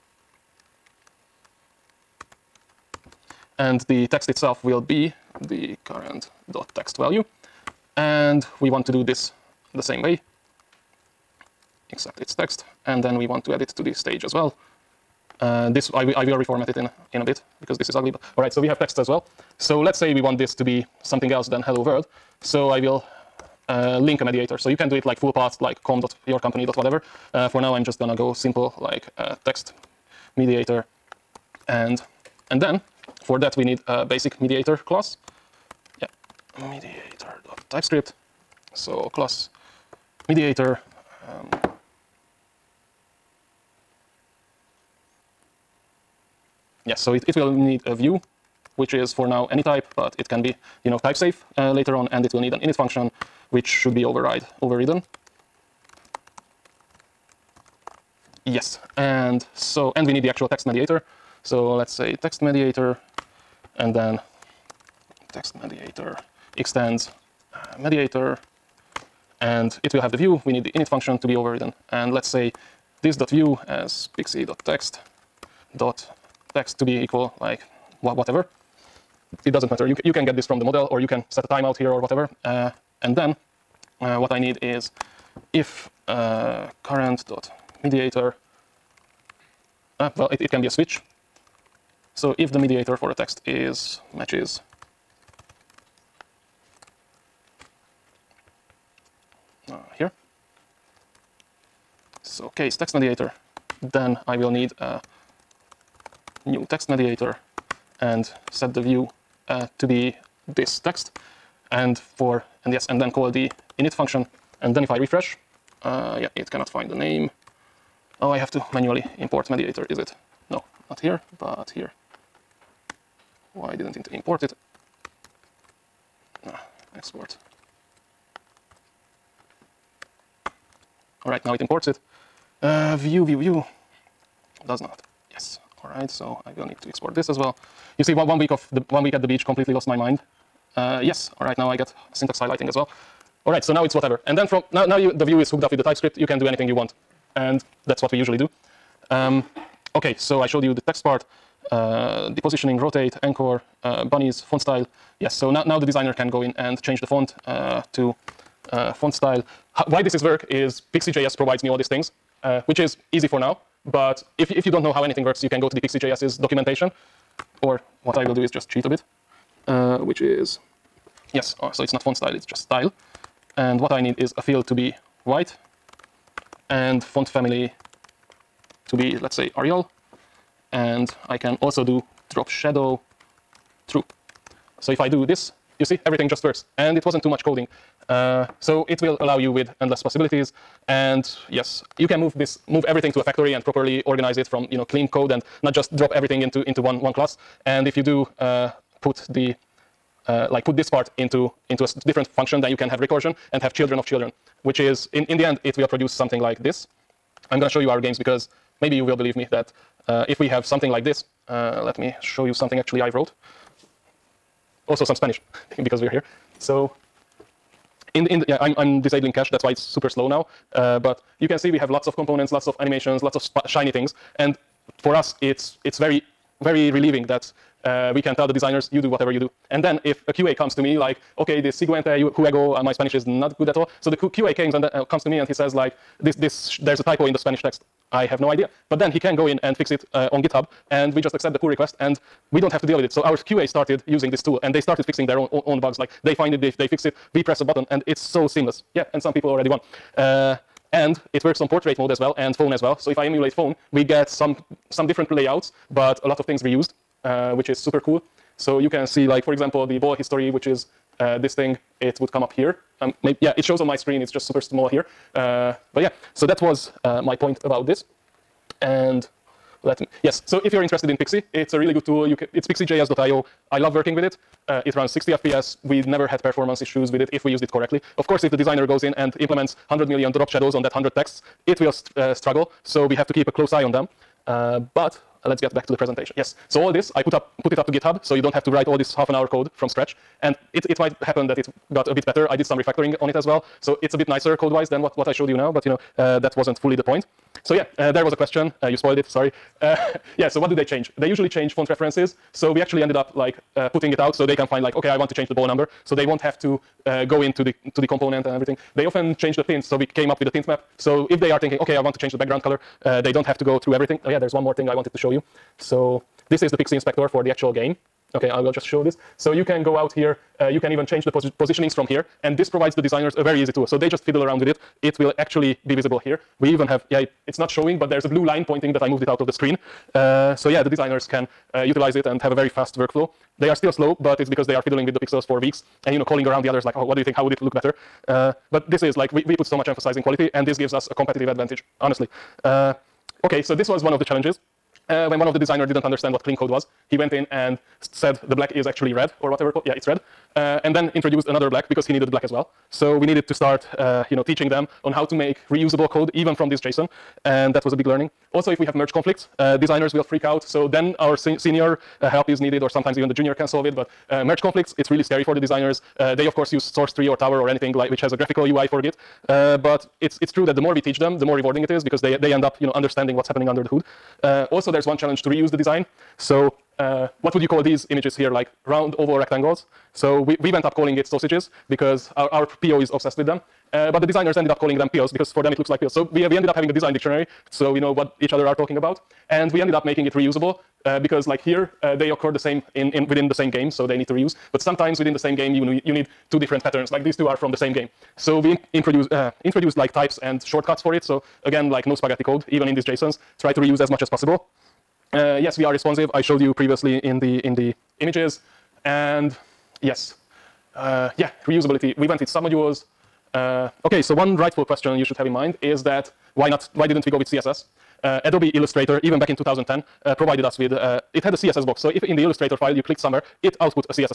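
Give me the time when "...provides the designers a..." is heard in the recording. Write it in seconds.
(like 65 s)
322 s.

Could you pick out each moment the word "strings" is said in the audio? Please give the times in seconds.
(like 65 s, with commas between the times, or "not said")
not said.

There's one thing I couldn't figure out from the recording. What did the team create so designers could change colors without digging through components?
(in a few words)
A tint map.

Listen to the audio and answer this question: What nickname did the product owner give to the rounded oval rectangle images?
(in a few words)
Sausages.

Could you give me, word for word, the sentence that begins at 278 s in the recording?
Of course, if the designer goes in and implements 100 million drop shadows on that 100 texts, it will st uh, struggle.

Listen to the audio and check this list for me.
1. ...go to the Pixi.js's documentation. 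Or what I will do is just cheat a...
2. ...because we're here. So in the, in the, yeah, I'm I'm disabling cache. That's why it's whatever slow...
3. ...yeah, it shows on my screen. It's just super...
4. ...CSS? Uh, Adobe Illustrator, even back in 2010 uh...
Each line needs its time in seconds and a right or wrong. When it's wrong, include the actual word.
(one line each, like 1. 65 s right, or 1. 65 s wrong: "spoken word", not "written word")
1. 165 s right
2. 215 s wrong: "super", not "whatever"
3. 263 s right
4. 417 s right.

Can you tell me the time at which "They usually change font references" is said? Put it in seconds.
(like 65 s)
301 s.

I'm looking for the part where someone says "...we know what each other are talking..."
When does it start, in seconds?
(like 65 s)
387 s.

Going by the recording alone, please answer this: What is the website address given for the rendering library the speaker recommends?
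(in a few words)
pixijs.io.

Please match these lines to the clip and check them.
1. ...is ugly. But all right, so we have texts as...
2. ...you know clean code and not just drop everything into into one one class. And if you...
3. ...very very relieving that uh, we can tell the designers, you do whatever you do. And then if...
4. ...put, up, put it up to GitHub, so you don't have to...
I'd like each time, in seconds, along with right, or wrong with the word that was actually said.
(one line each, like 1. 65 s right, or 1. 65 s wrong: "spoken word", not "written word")
1. 17 s right
2. 194 s right
3. 225 s right
4. 287 s right.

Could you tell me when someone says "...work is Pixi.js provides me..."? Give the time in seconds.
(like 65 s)
160 s.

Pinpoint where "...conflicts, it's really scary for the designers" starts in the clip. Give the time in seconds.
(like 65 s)
364 s.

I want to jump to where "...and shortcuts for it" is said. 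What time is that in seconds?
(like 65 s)
400 s.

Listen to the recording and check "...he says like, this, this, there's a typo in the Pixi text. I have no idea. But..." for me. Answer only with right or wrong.
wrong.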